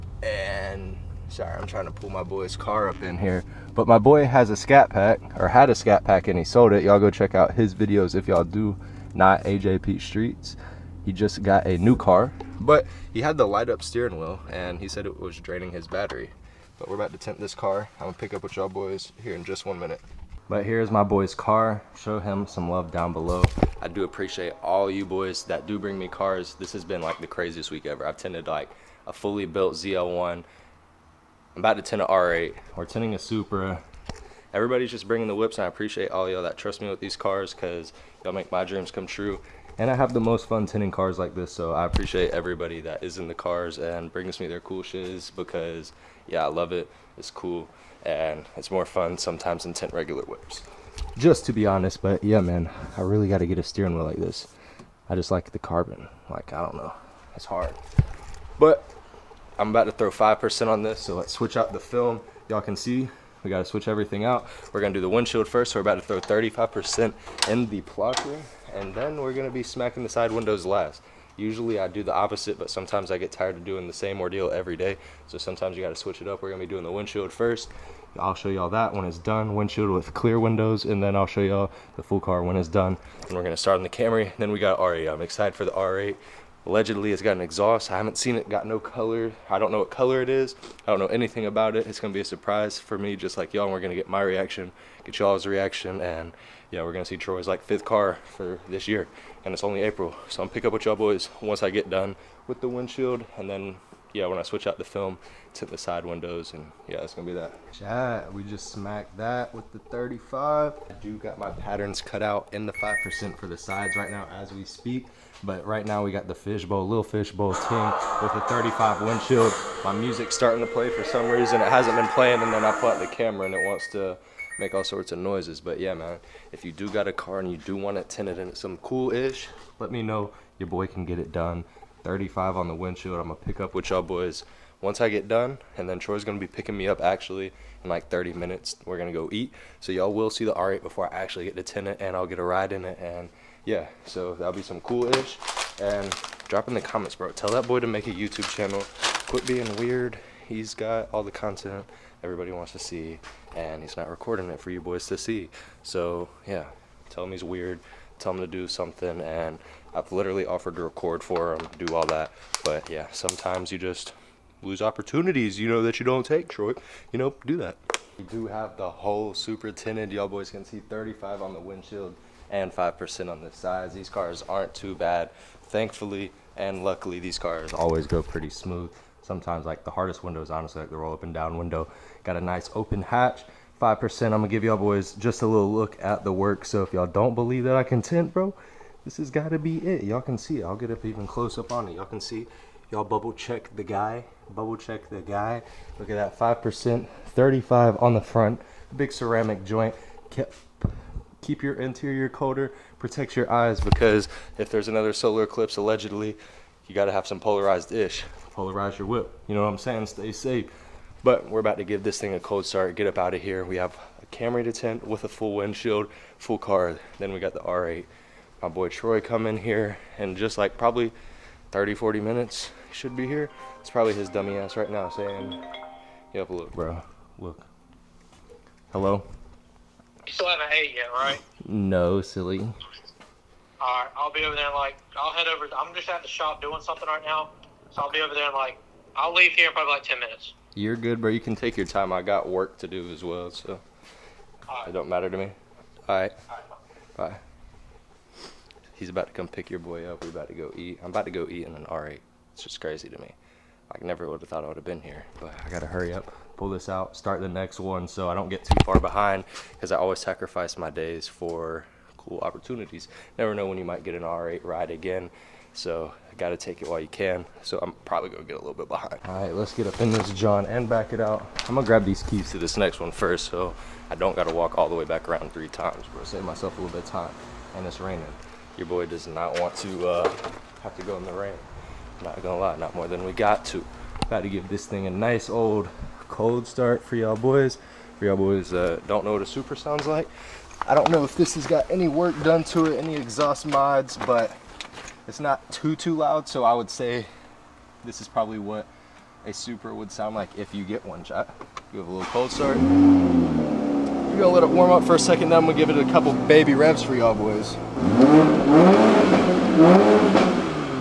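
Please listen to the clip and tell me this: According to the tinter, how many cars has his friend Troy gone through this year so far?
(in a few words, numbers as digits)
5.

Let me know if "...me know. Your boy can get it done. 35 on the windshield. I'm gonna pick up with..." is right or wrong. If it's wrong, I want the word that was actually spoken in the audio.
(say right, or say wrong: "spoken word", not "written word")
right.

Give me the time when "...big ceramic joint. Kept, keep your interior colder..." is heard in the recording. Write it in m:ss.
3:18.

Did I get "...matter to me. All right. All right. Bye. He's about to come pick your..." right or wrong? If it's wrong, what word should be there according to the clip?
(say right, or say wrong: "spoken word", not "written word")
right.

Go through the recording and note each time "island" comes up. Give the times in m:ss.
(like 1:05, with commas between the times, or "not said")
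not said.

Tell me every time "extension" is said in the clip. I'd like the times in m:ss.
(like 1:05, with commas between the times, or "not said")
not said.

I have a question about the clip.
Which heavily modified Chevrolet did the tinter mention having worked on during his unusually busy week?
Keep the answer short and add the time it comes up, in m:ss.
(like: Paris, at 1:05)
ZL1, at 0:29.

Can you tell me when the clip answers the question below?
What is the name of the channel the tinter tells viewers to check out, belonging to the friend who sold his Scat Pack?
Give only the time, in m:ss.
0:09.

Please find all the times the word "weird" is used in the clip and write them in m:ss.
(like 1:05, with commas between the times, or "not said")
2:29, 2:37.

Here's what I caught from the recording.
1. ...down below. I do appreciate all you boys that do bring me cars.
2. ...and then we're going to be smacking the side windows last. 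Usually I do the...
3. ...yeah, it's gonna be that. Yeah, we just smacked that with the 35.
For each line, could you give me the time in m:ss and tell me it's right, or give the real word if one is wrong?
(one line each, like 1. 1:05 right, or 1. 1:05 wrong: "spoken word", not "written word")
1. 0:22 right
2. 1:08 right
3. 1:46 right.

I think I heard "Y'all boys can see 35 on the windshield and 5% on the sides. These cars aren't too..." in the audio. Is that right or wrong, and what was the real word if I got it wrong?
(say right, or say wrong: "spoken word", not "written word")
right.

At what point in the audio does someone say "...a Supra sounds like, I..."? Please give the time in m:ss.
4:49.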